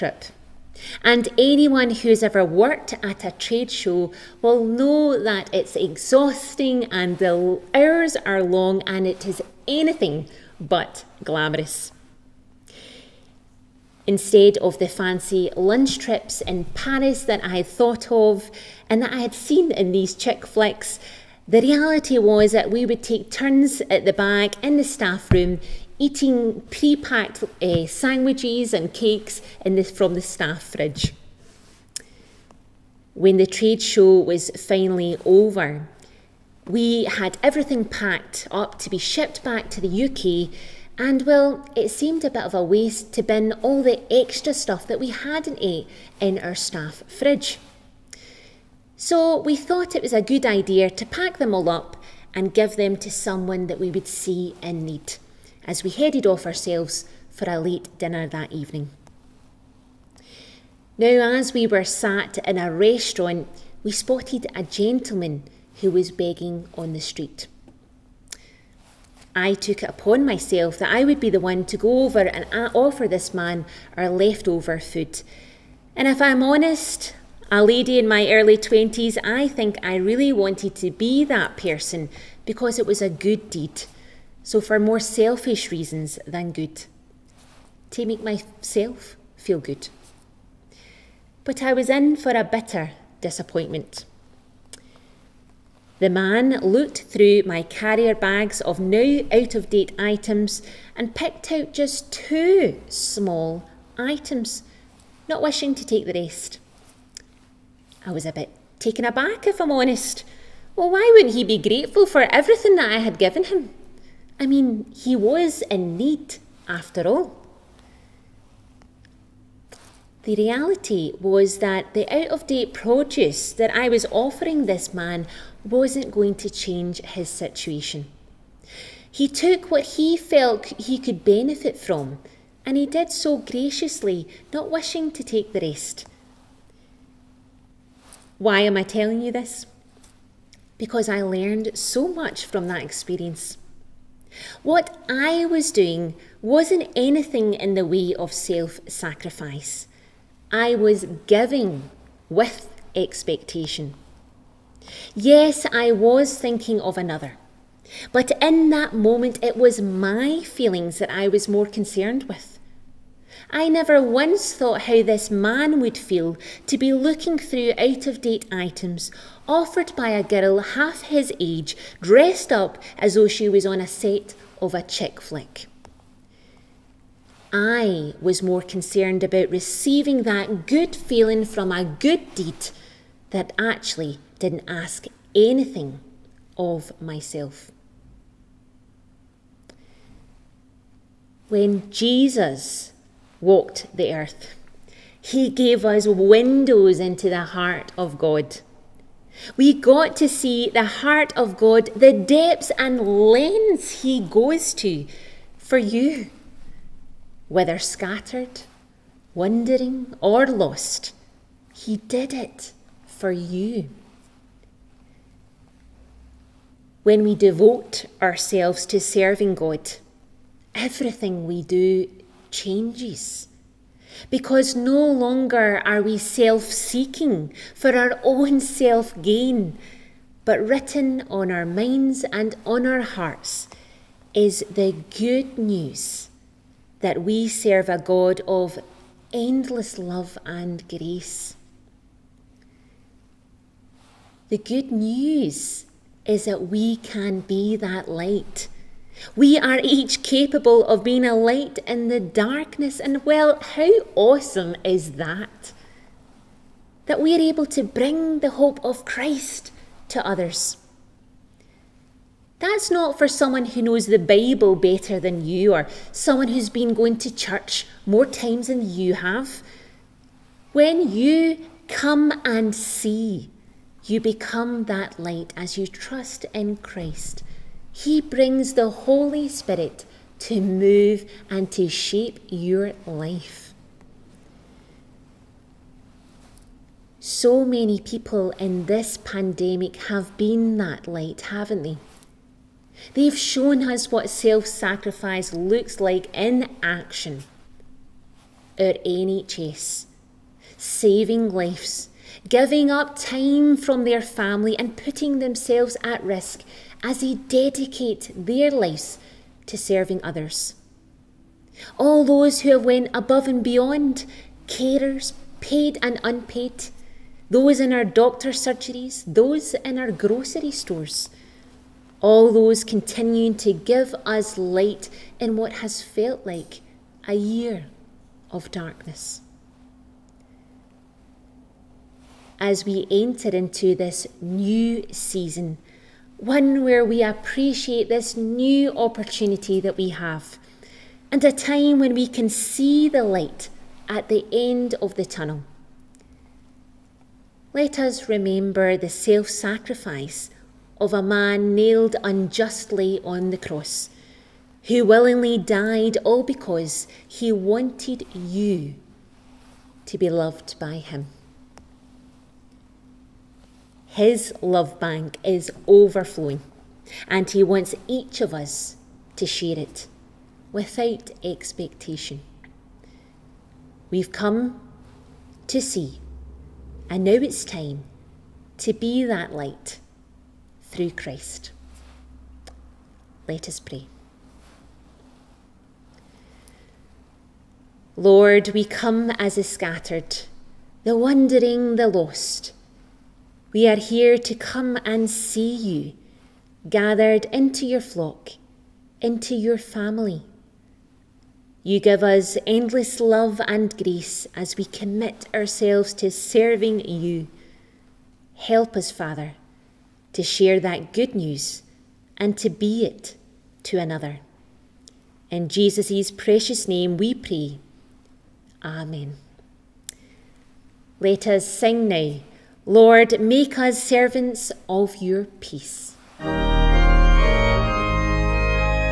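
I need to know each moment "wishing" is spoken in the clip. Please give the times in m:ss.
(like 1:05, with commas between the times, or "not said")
1:45, 2:14.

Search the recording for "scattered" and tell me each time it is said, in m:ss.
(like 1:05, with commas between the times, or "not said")
3:27, 6:29.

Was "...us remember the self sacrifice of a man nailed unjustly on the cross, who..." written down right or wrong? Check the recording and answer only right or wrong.
right.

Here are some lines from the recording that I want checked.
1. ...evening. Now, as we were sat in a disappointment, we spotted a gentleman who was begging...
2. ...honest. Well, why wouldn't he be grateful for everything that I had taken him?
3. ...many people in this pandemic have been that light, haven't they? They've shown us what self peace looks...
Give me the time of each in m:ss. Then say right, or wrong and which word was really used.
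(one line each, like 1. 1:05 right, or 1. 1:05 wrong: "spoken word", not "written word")
1. 0:58 wrong: "restaurant", not "disappointment"
2. 1:49 wrong: "given", not "taken"
3. 4:47 wrong: "sacrifice", not "peace".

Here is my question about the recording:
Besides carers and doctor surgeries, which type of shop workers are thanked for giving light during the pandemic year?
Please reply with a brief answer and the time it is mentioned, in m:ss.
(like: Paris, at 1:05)
Grocery stores, at 5:20.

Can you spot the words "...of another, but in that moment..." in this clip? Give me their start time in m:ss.
2:36.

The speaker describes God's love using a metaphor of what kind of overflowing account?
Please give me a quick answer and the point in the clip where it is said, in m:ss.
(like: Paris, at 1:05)
Love bank, at 6:04.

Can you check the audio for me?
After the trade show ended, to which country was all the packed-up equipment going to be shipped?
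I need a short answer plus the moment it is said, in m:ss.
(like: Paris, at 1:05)
UK, at 0:40.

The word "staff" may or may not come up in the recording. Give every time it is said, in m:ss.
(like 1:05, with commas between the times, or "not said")
0:24, 0:30, 0:46.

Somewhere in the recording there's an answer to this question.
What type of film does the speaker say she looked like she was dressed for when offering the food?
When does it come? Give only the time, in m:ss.
2:54.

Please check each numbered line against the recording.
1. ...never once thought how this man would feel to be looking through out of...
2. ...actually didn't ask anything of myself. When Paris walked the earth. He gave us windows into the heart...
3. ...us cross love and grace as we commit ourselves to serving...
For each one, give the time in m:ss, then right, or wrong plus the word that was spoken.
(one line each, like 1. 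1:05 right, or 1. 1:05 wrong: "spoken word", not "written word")
1. 2:43 right
2. 3:03 wrong: "Jesus", not "Paris"
3. 6:42 wrong: "endless", not "cross".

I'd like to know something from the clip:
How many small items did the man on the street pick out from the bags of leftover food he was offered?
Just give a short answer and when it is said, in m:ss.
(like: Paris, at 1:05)
2, at 1:42.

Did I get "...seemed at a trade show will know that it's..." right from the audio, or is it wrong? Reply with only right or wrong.
wrong.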